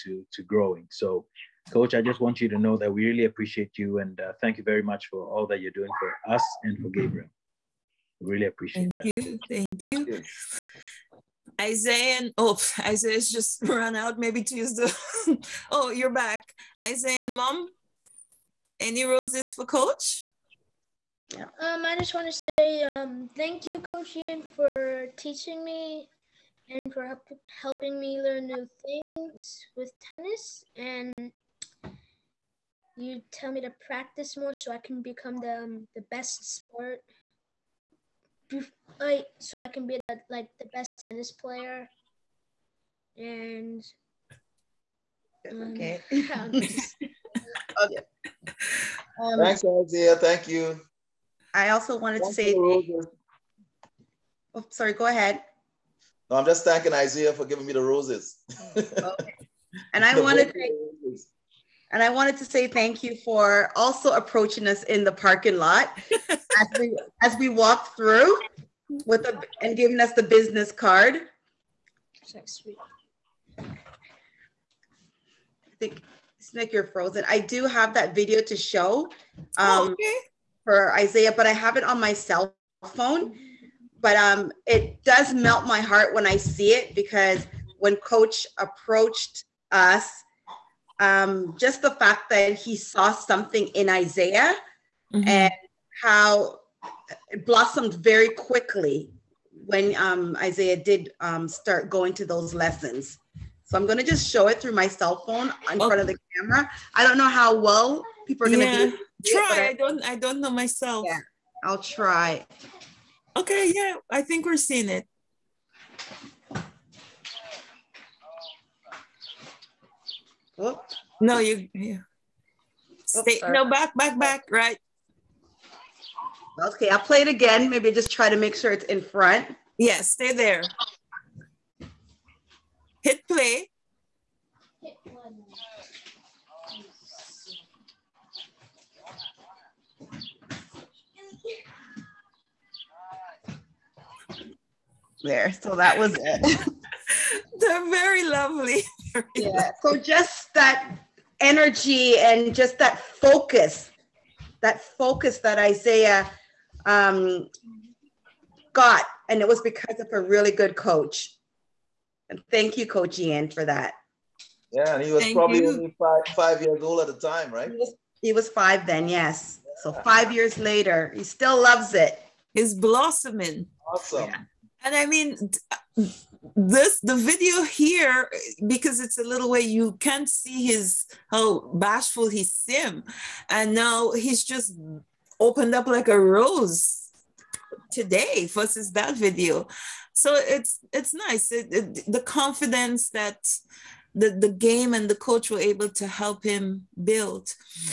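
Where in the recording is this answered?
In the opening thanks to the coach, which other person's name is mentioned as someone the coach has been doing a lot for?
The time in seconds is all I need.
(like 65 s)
6 s.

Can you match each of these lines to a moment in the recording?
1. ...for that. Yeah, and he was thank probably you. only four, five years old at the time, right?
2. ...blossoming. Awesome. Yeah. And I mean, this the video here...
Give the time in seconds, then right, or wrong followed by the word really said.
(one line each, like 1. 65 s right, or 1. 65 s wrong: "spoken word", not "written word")
1. 163 s wrong: "five", not "four"
2. 172 s right.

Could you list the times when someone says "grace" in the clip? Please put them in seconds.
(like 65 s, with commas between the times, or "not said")
not said.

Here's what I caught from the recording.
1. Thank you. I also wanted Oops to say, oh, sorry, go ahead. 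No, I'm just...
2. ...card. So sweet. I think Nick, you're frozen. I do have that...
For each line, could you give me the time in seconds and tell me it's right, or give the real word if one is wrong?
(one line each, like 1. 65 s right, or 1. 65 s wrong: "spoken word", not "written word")
1. 50 s wrong: "Thank", not "Oops"
2. 70 s right.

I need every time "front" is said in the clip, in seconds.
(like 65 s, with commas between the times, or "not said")
105 s, 128 s.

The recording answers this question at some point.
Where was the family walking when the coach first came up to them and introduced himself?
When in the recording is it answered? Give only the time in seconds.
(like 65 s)
65 s.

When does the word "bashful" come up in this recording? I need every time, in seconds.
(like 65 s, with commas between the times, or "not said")
181 s.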